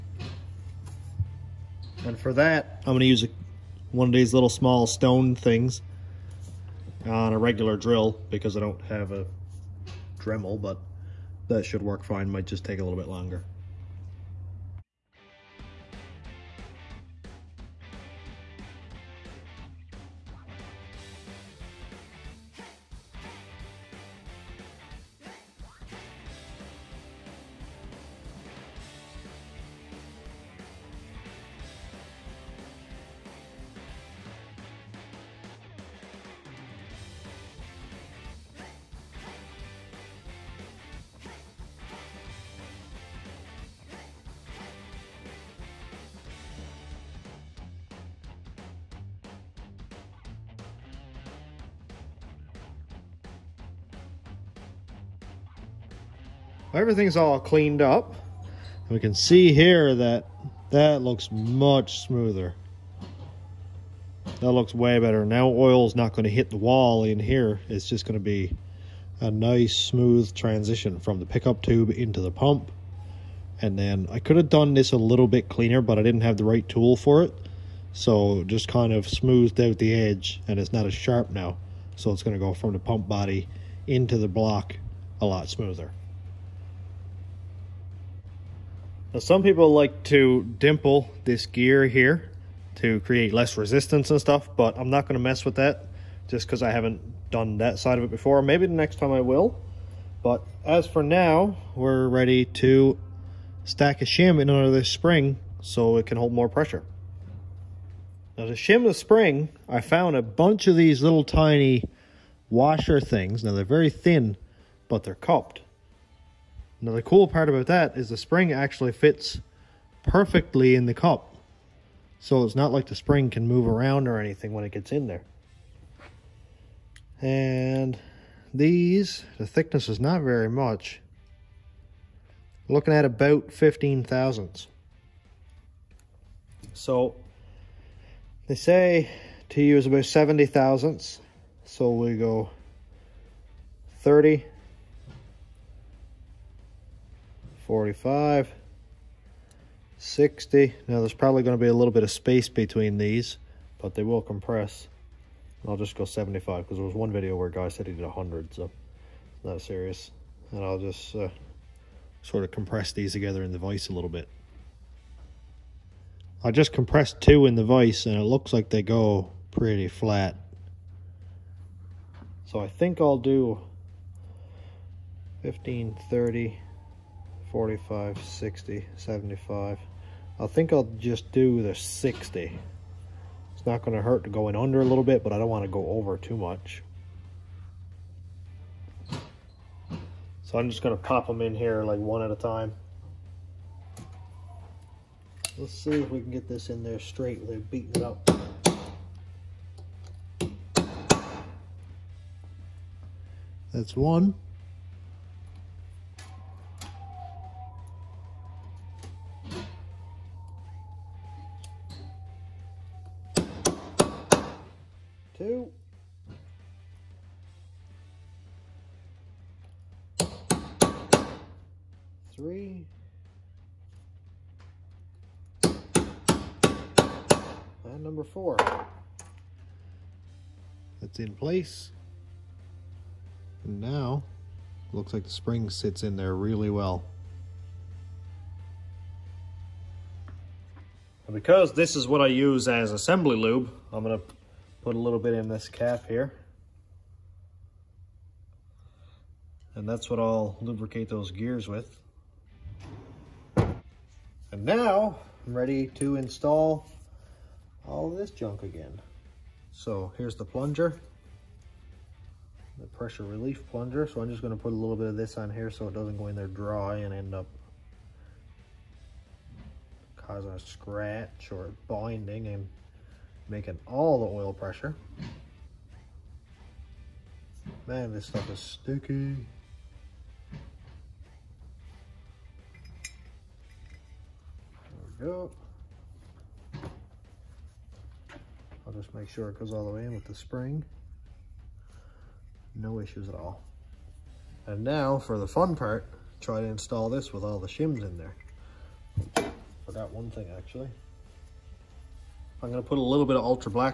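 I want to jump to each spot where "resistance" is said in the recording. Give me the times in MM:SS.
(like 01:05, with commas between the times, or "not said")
01:33.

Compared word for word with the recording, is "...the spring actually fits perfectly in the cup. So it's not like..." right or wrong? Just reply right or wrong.
right.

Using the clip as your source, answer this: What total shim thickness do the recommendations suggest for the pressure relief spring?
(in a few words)
70 thousandths.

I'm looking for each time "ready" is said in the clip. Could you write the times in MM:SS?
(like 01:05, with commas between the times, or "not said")
01:42, 04:15.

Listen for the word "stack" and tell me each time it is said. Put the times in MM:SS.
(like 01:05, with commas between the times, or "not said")
01:43.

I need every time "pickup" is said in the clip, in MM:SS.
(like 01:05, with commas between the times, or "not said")
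01:11.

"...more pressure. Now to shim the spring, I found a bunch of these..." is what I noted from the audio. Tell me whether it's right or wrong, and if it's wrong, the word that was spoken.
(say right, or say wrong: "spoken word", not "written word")
right.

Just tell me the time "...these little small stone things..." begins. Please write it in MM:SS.
00:04.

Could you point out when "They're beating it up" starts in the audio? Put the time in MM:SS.
03:17.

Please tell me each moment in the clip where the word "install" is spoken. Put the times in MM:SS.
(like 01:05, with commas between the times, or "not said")
04:16, 04:56.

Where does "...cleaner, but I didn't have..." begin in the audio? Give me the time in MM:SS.
01:15.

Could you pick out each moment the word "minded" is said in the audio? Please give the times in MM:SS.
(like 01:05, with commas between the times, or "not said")
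not said.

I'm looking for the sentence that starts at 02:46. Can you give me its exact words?
I just compressed two in the vise and it looks like they go pretty flat.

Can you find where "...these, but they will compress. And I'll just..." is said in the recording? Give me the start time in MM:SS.
02:32.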